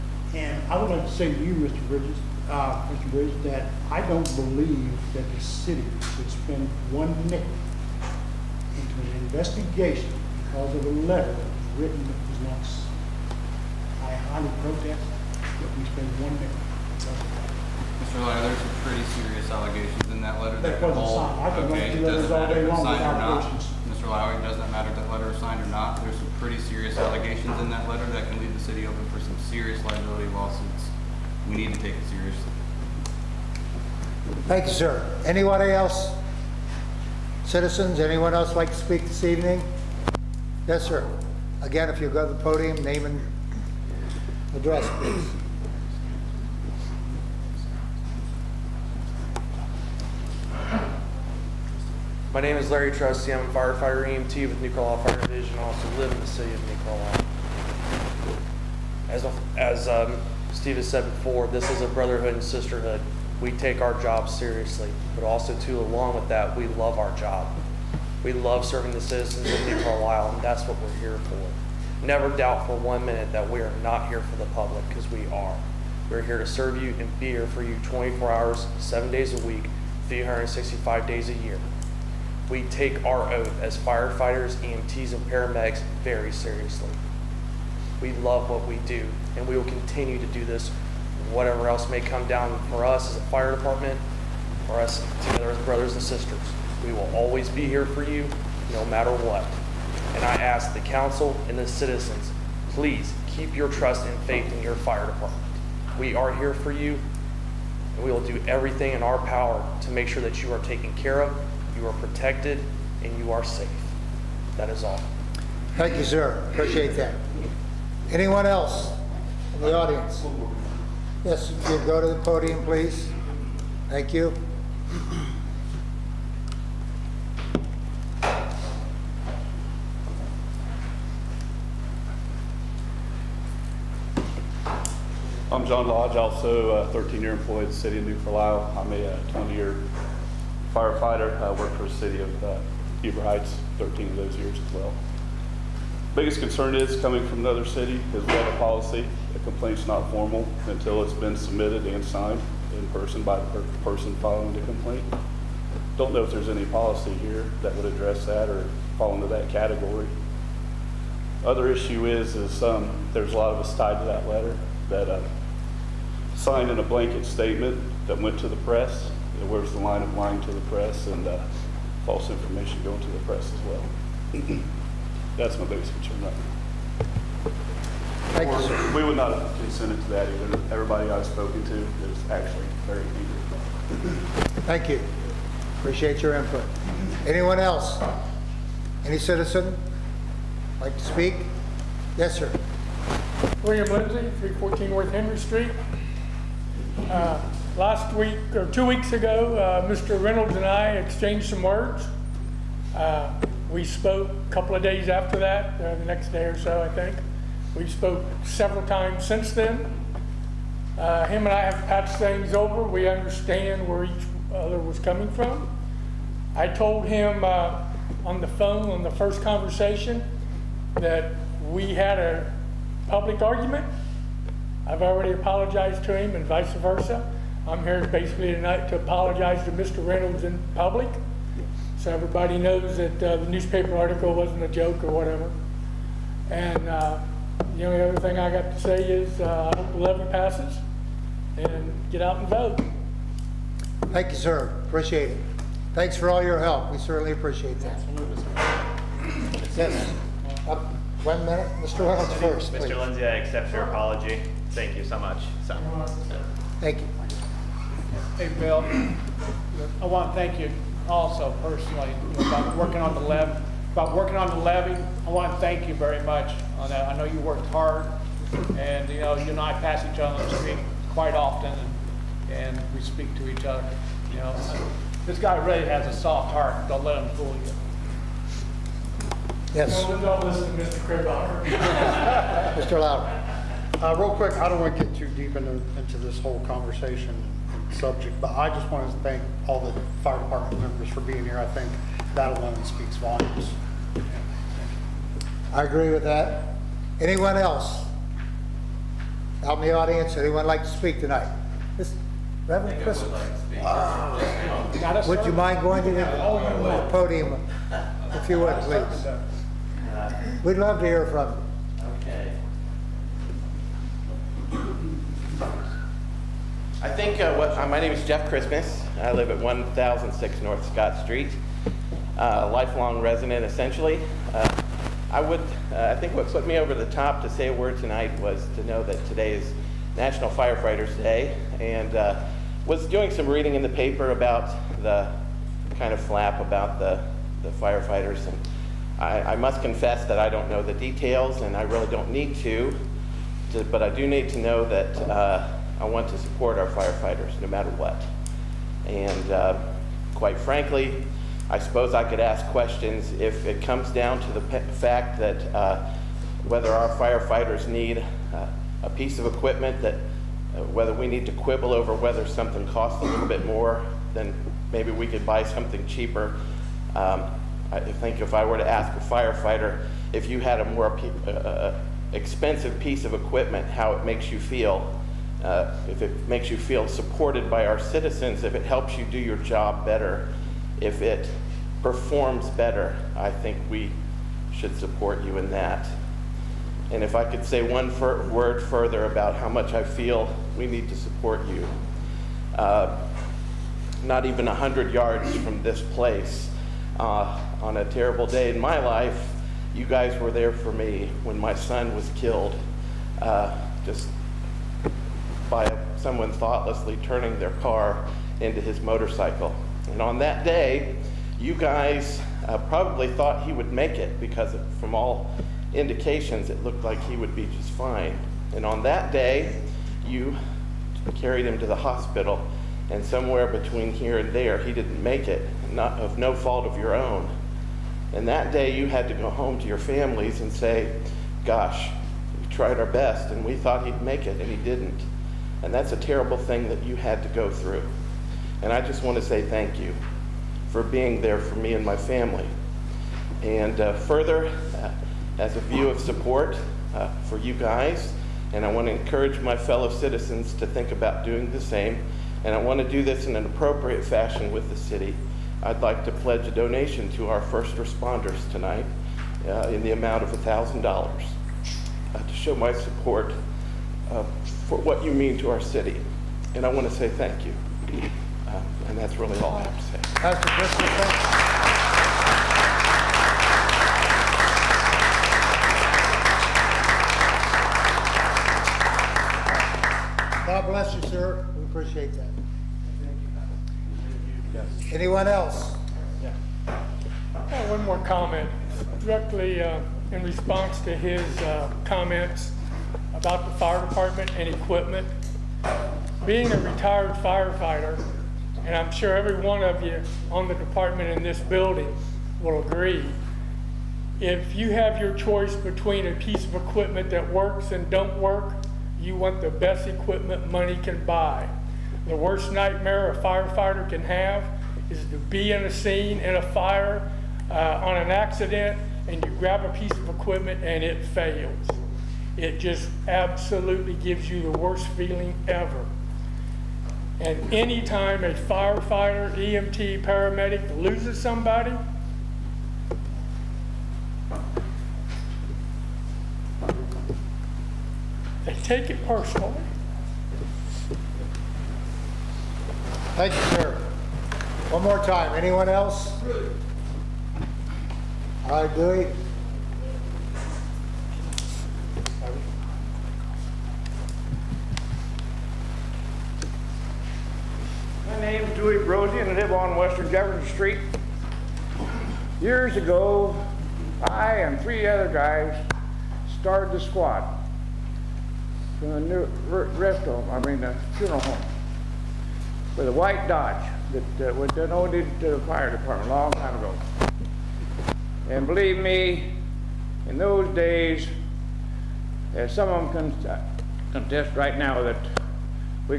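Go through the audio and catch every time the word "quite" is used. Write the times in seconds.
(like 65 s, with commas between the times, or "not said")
271 s, 350 s.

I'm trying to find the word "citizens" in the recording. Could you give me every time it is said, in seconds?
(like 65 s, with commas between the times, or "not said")
37 s, 69 s, 101 s, 189 s, 377 s, 450 s.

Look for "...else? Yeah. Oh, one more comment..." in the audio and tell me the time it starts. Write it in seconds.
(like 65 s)
485 s.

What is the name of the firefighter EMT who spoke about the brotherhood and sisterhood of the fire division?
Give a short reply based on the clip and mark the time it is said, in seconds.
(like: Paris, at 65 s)
Larry Trusty, at 52 s.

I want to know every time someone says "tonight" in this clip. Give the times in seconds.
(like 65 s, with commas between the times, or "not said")
228 s, 301 s, 327 s, 458 s.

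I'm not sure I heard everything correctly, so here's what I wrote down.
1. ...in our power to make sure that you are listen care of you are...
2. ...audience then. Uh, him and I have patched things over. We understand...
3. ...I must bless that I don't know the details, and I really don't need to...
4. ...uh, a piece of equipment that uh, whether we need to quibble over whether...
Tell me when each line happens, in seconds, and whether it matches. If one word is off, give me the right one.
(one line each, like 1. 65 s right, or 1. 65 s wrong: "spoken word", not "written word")
1. 108 s wrong: "taken", not "listen"
2. 209 s wrong: "since", not "audience"
3. 339 s wrong: "confess", not "bless"
4. 358 s right.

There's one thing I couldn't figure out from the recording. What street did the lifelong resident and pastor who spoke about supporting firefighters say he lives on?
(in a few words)
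North Scott Street.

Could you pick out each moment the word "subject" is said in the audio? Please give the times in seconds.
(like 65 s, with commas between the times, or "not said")
287 s.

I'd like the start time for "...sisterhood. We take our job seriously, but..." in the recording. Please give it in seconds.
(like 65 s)
62 s.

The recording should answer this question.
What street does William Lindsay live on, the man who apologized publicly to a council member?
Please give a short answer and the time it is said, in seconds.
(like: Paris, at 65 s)
North Henry Street, at 194 s.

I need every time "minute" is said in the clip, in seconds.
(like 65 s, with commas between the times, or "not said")
73 s, 251 s.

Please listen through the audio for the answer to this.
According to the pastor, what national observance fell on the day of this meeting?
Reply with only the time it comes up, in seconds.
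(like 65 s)
330 s.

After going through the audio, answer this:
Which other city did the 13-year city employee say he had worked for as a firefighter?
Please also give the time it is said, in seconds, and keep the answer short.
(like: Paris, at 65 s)
Huber Heights, at 143 s.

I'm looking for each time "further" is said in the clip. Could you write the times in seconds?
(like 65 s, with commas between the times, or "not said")
388 s, 444 s.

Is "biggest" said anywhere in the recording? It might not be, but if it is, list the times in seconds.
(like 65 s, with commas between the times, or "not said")
146 s, 175 s.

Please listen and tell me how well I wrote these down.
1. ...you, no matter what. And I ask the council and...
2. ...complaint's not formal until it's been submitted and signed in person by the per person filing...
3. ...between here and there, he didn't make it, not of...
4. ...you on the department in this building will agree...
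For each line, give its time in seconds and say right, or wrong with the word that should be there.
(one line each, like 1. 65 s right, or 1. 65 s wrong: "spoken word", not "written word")
1. 98 s right
2. 149 s right
3. 423 s right
4. 500 s right.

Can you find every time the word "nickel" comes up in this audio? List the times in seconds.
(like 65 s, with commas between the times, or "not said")
7 s, 16 s.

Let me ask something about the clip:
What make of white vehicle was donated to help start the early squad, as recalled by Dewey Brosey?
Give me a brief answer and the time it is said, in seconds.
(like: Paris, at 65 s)
Dodge, at 573 s.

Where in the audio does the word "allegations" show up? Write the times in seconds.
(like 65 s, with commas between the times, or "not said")
19 s, 26 s.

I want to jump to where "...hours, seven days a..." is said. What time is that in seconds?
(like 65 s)
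78 s.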